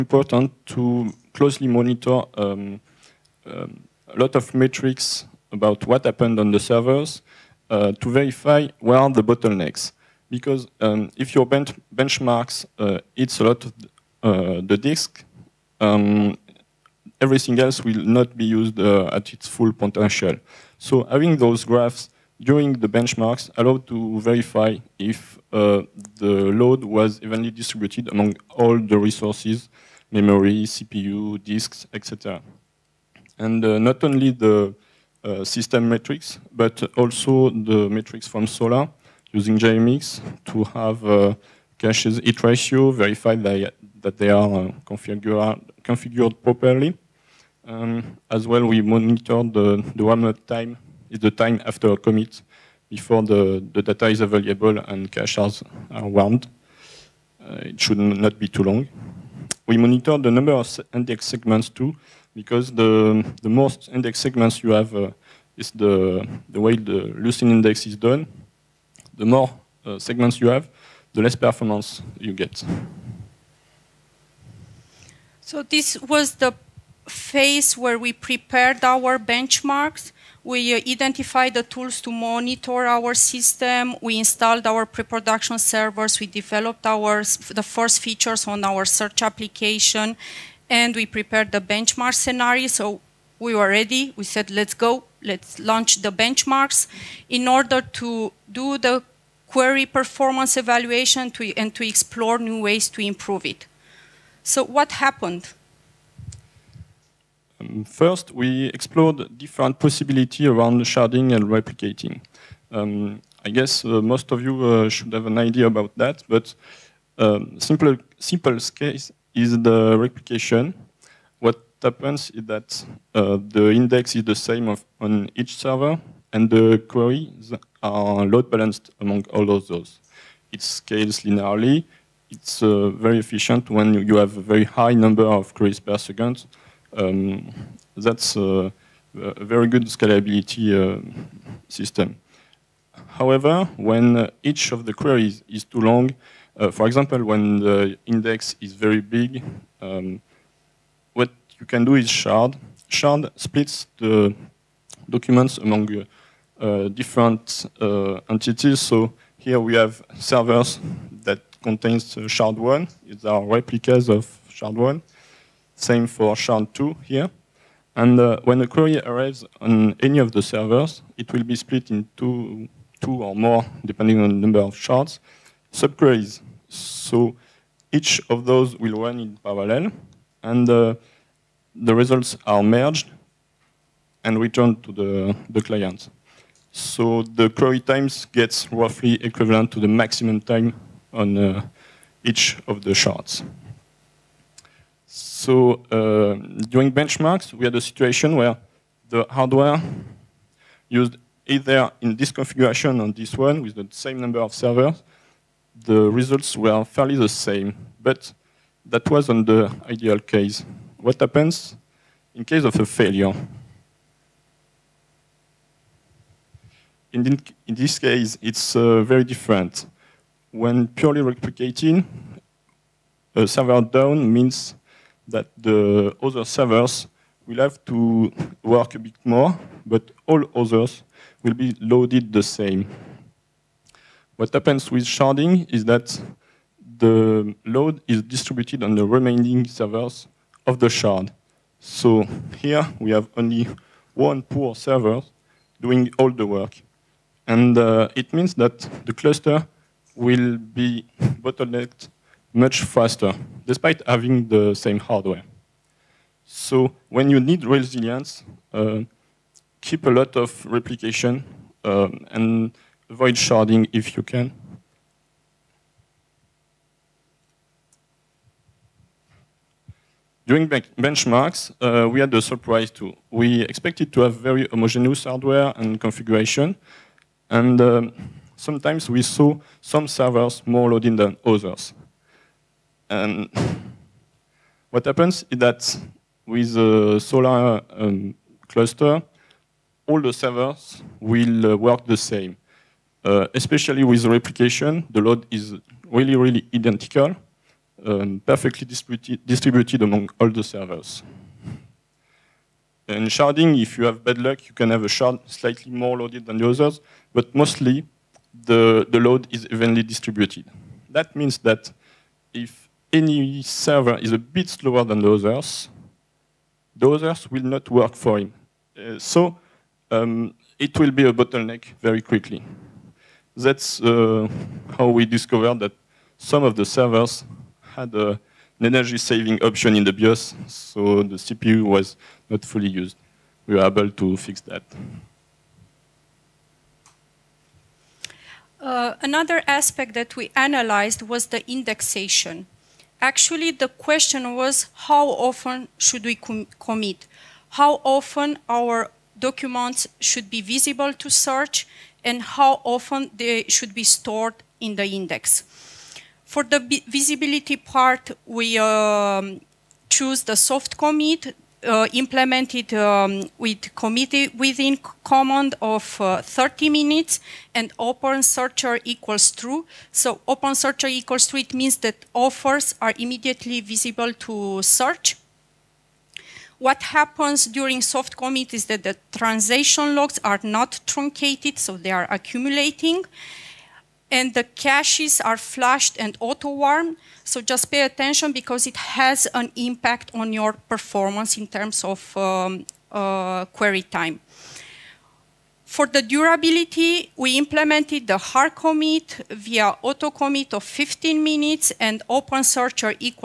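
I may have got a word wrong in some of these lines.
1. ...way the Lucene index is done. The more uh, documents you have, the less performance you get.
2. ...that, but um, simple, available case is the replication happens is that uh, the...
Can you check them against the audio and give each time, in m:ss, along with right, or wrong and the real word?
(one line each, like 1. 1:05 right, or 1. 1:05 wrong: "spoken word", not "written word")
1. 1:06 wrong: "segments", not "documents"
2. 1:55 wrong: "simple", not "available".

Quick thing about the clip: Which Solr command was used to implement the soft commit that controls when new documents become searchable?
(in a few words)
commitWithin.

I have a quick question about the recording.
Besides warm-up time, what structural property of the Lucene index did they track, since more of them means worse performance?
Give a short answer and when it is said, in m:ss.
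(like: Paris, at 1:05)
number of index segments, at 1:00.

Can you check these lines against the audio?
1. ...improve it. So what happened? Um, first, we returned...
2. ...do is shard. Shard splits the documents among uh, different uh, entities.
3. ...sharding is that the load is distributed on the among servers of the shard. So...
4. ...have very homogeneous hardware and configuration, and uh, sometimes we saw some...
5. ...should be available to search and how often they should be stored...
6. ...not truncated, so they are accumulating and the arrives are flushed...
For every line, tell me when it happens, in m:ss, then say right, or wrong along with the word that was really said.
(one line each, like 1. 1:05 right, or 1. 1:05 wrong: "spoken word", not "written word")
1. 1:43 wrong: "explored", not "returned"
2. 2:31 right
3. 3:55 wrong: "remaining", not "among"
4. 4:34 right
5. 5:50 wrong: "visible", not "available"
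6. 6:20 wrong: "caches", not "arrives".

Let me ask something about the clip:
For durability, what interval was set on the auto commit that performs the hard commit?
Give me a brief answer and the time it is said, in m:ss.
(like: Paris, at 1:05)
15 minutes, at 6:40.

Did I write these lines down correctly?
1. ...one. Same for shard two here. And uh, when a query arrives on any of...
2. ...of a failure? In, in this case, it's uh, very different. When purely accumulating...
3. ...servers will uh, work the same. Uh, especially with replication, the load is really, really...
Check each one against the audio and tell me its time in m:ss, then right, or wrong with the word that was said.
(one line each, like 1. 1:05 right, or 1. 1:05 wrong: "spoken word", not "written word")
1. 2:44 right
2. 3:32 wrong: "replicating", not "accumulating"
3. 4:50 right.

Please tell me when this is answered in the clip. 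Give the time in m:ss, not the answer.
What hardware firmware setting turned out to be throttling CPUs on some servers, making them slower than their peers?
5:28.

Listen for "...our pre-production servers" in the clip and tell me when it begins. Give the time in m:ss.
1:24.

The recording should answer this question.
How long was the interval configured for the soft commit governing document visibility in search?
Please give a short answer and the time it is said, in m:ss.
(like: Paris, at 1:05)
30 minutes, at 6:06.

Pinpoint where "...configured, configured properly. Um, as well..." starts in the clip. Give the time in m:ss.
0:44.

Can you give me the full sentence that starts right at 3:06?
So the query times gets roughly equivalent to the maximum time on uh, each of the shards.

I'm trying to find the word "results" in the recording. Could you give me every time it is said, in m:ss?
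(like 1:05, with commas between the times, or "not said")
3:01, 3:26.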